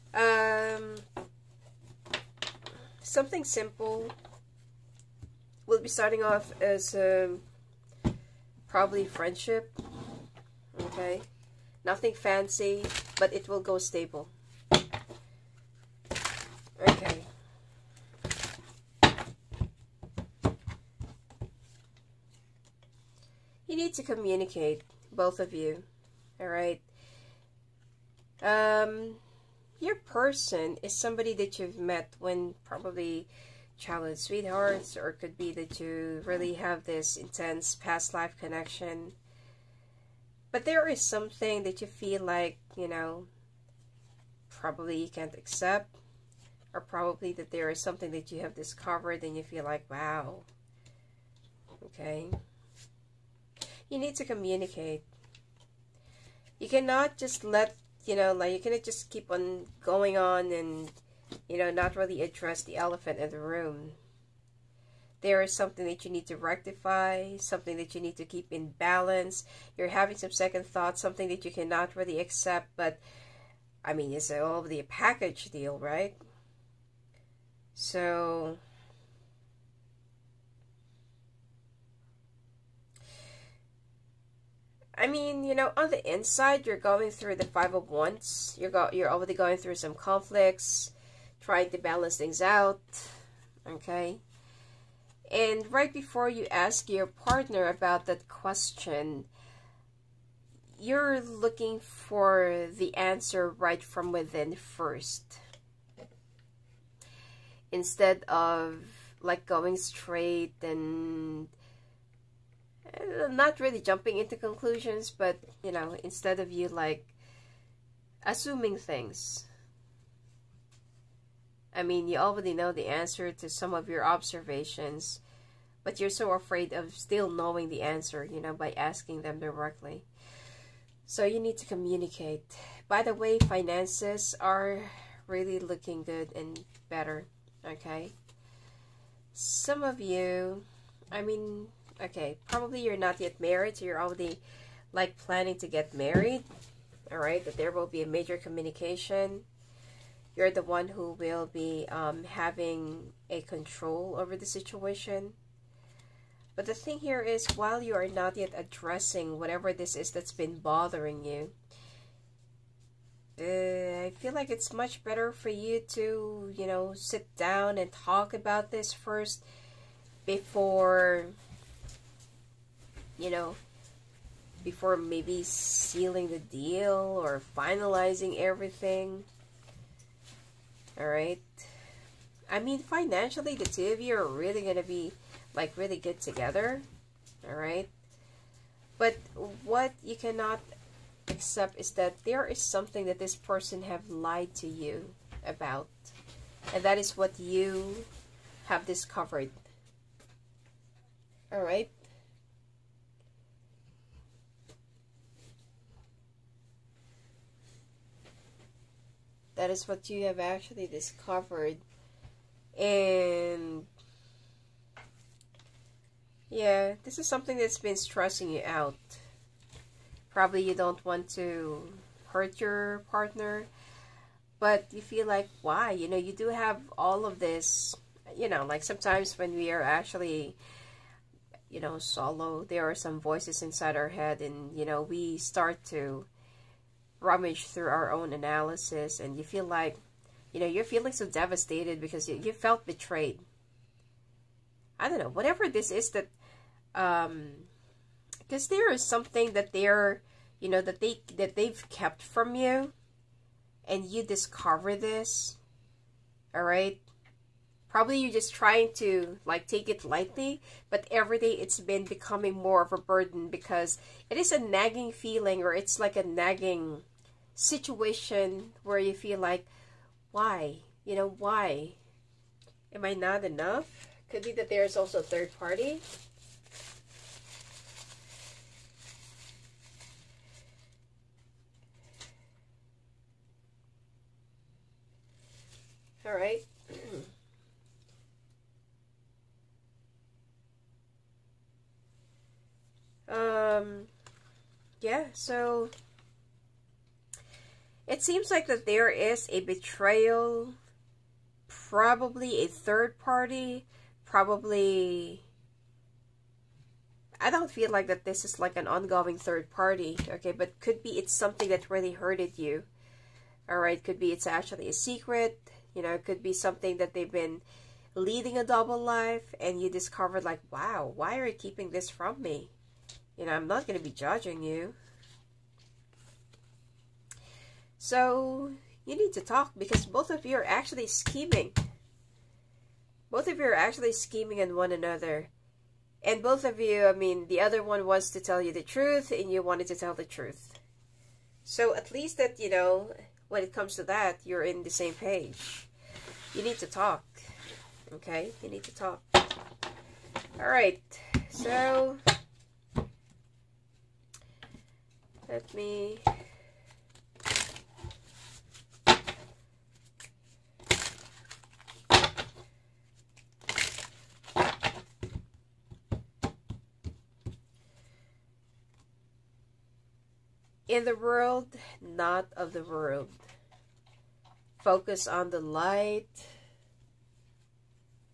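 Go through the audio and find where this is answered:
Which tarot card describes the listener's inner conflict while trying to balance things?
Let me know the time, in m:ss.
1:27.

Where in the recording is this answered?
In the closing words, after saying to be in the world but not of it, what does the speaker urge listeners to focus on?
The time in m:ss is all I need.
6:15.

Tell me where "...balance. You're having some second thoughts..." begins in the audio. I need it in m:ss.
1:08.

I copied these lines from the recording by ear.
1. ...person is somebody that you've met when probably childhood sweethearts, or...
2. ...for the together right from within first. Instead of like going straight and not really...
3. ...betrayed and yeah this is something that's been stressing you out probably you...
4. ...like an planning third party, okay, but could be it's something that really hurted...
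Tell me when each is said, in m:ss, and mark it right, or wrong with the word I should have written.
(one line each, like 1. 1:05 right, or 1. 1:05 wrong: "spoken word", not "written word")
1. 0:29 right
2. 1:41 wrong: "answer", not "together"
3. 3:30 wrong: "discovered", not "betrayed"
4. 5:08 wrong: "ongoing", not "planning".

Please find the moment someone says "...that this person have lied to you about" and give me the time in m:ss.
3:13.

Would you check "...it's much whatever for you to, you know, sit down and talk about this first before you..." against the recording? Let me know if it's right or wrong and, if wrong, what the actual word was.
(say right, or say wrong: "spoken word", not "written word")
wrong: "better", not "whatever".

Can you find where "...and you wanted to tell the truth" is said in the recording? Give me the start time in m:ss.
5:39.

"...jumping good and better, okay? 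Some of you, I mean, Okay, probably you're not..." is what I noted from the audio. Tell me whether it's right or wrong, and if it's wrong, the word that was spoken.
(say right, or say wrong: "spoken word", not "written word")
wrong: "looking", not "jumping".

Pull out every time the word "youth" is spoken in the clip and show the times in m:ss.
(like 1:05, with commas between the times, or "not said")
not said.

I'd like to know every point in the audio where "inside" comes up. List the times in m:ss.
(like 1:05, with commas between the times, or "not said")
1:26, 3:53.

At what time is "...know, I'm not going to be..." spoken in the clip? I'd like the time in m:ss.
5:23.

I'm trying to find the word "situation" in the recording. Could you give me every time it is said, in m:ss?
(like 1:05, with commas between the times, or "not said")
2:34, 4:27.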